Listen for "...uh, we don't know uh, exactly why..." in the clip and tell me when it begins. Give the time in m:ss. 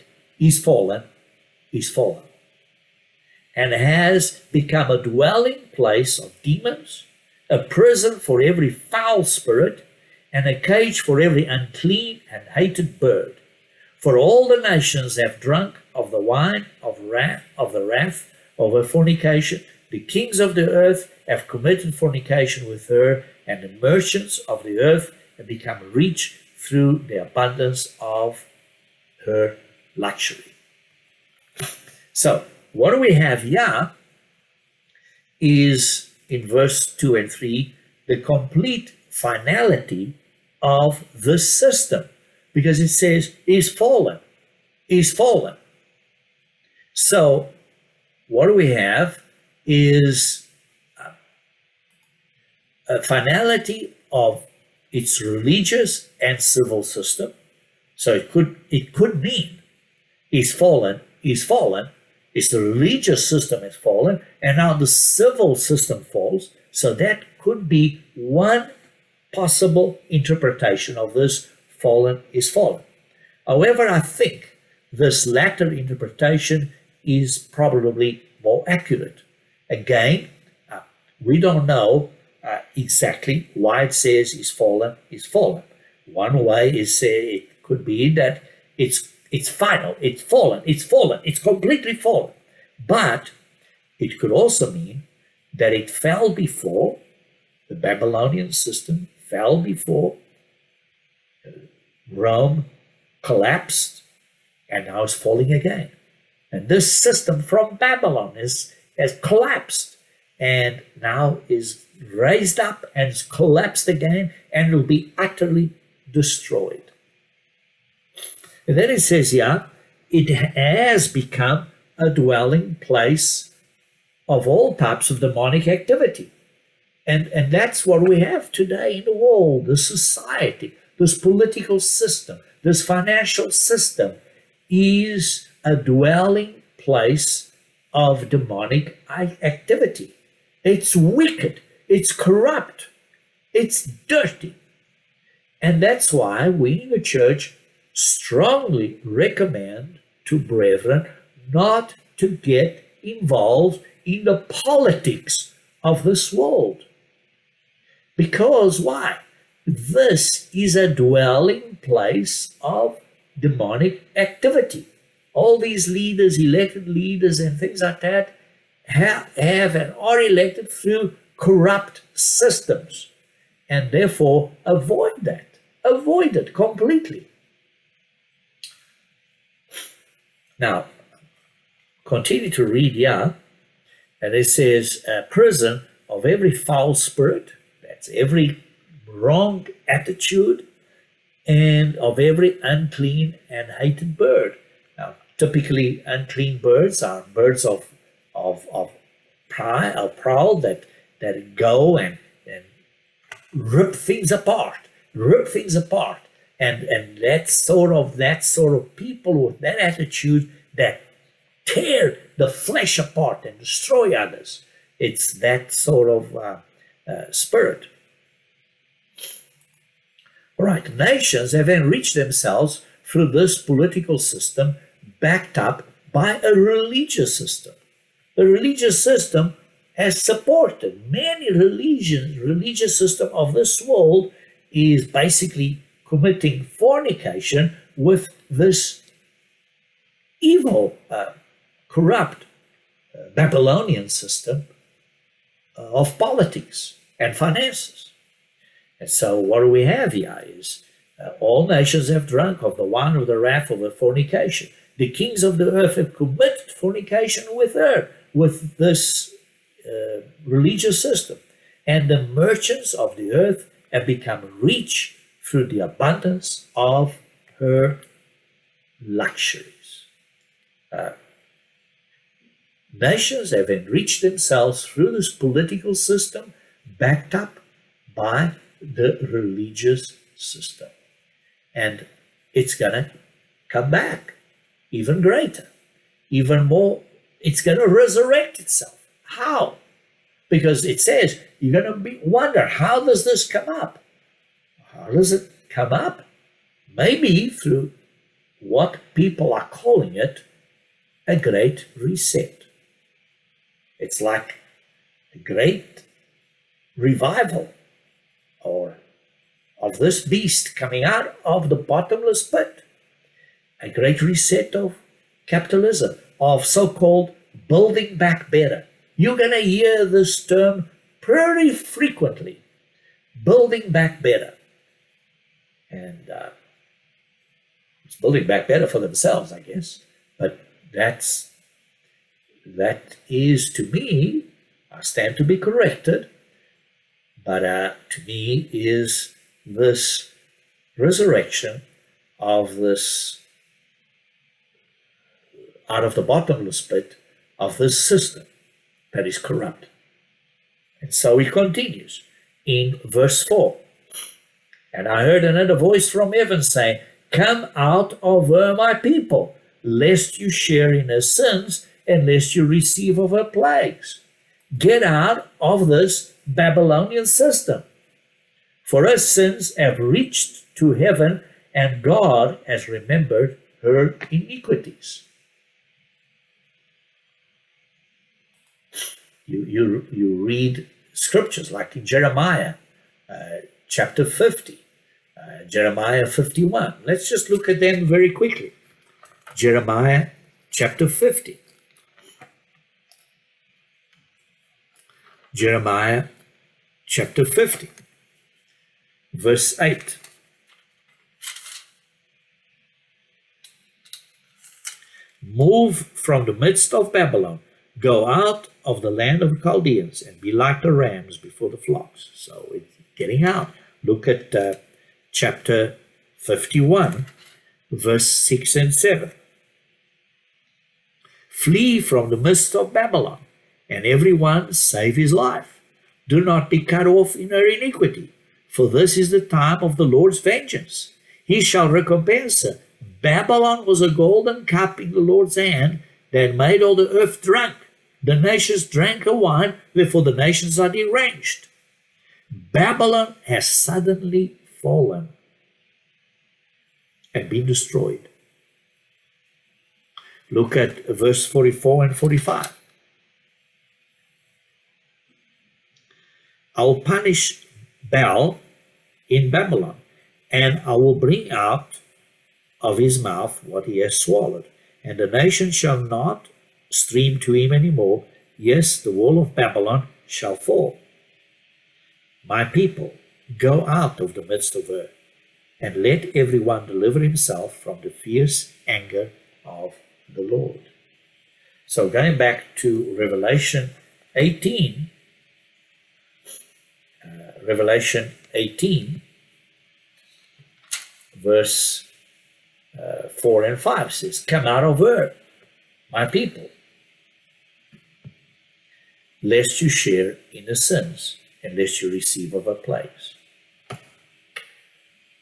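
1:20.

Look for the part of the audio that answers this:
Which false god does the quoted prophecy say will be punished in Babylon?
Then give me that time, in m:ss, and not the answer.
7:38.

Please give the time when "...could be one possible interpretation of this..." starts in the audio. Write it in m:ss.
1:07.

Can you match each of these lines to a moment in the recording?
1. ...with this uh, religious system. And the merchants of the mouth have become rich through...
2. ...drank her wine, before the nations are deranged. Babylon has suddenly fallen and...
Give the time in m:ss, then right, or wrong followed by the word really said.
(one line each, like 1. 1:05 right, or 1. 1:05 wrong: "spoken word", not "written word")
1. 4:18 wrong: "earth", not "mouth"
2. 7:18 right.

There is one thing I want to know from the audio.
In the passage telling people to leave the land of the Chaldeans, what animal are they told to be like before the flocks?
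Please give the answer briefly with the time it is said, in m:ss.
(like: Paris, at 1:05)
rams, at 6:50.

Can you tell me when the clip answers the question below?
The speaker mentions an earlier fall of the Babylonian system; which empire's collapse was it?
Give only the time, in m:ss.
1:42.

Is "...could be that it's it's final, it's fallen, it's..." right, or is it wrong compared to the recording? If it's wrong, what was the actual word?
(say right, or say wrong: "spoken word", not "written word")
right.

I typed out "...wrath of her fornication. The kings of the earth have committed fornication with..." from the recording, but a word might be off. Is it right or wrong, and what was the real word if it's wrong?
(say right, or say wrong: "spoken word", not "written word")
right.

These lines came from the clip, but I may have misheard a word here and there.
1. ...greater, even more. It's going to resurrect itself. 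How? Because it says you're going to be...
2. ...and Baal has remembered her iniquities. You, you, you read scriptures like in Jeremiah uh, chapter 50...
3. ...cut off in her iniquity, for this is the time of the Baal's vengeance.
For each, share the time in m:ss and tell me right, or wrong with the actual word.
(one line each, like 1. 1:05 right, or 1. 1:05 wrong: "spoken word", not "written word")
1. 4:45 right
2. 6:11 wrong: "God", not "Baal"
3. 7:06 wrong: "Lord", not "Baal".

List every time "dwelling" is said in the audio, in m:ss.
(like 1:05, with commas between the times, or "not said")
0:05, 2:02, 2:15, 2:40.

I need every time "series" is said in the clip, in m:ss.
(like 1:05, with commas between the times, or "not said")
not said.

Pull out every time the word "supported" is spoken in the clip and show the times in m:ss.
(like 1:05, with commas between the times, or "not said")
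3:50.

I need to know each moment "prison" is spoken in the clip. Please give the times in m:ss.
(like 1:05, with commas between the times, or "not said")
0:07, 3:05.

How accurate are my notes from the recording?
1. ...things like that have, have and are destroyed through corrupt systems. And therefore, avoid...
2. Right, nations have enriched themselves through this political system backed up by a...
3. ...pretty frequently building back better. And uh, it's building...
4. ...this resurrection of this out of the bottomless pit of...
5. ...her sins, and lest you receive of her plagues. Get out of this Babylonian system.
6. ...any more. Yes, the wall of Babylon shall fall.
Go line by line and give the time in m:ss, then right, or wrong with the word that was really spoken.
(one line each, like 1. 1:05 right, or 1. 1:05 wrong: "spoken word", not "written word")
1. 2:47 wrong: "elected", not "destroyed"
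2. 3:40 right
3. 5:21 right
4. 5:39 right
5. 6:01 right
6. 7:47 right.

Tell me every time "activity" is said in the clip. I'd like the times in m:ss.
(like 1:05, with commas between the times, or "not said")
2:05, 2:19, 2:44.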